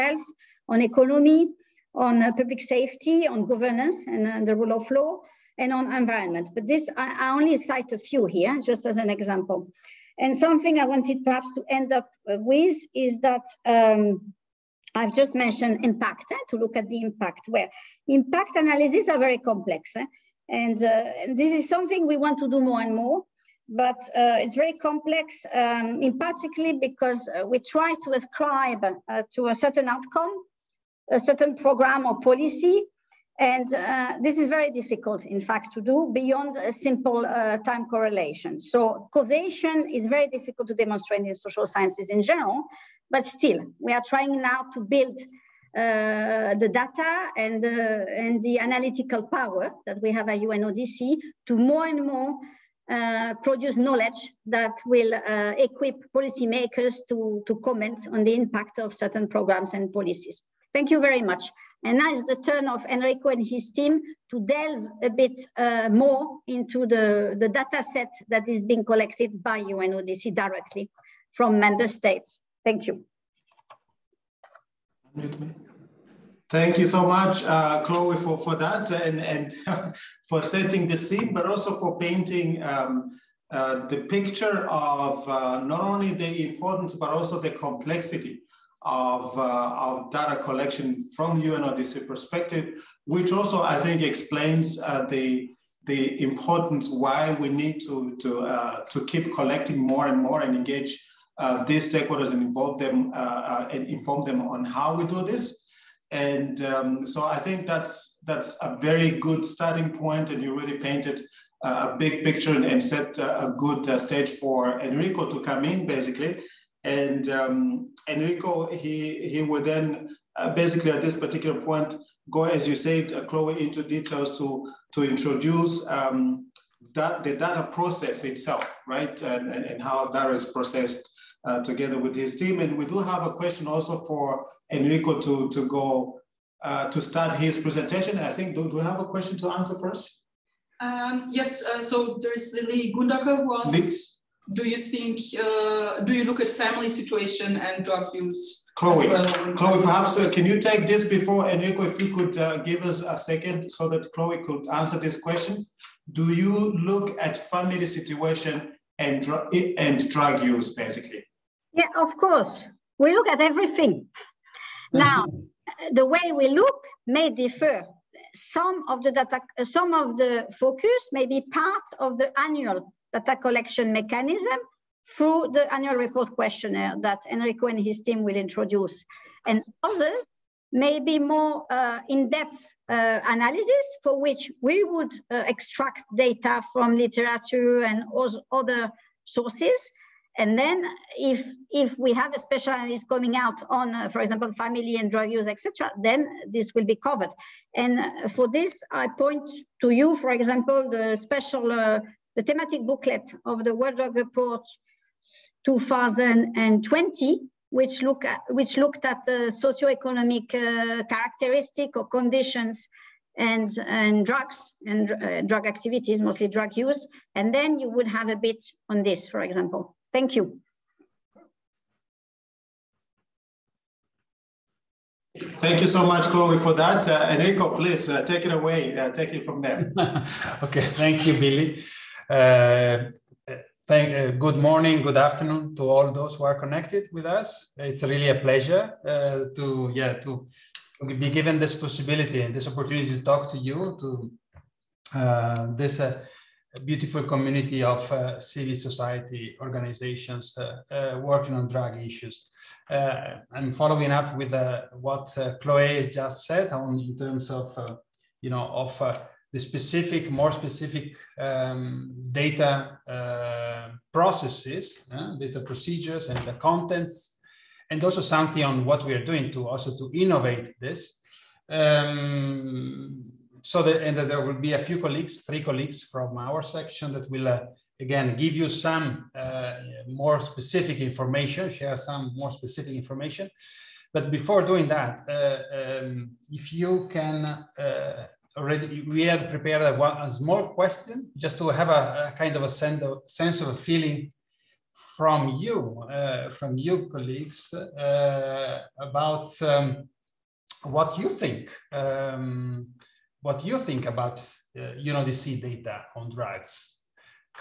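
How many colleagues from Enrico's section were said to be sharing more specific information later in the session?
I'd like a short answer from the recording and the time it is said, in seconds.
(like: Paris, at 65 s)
3, at 275 s.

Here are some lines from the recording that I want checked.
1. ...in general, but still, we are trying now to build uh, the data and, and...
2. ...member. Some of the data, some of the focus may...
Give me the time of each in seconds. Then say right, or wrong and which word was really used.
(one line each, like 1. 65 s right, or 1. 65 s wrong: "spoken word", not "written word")
1. 42 s right
2. 167 s wrong: "differ", not "member".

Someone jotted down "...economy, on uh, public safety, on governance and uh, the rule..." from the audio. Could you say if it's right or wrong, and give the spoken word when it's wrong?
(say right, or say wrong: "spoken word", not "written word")
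right.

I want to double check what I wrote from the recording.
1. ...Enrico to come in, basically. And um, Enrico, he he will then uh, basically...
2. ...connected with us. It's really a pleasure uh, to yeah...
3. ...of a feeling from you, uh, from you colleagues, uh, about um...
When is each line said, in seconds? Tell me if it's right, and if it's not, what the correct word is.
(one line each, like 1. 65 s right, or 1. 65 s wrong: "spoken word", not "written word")
1. 114 s right
2. 236 s right
3. 293 s right.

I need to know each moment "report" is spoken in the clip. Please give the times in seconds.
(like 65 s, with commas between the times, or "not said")
175 s, 204 s.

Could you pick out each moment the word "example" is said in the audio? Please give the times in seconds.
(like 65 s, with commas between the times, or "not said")
9 s, 194 s, 200 s, 219 s.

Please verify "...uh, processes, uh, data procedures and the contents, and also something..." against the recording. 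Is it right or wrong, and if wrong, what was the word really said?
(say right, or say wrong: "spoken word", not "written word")
right.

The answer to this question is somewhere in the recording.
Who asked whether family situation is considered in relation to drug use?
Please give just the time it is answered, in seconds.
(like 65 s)
142 s.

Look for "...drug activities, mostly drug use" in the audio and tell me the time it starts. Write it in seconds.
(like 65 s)
215 s.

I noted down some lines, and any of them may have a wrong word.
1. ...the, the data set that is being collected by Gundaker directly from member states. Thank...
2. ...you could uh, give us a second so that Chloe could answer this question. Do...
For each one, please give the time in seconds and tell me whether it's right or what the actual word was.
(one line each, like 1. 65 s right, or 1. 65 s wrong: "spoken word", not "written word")
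1. 66 s wrong: "UNODC", not "Gundaker"
2. 152 s right.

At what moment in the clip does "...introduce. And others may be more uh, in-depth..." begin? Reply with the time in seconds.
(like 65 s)
178 s.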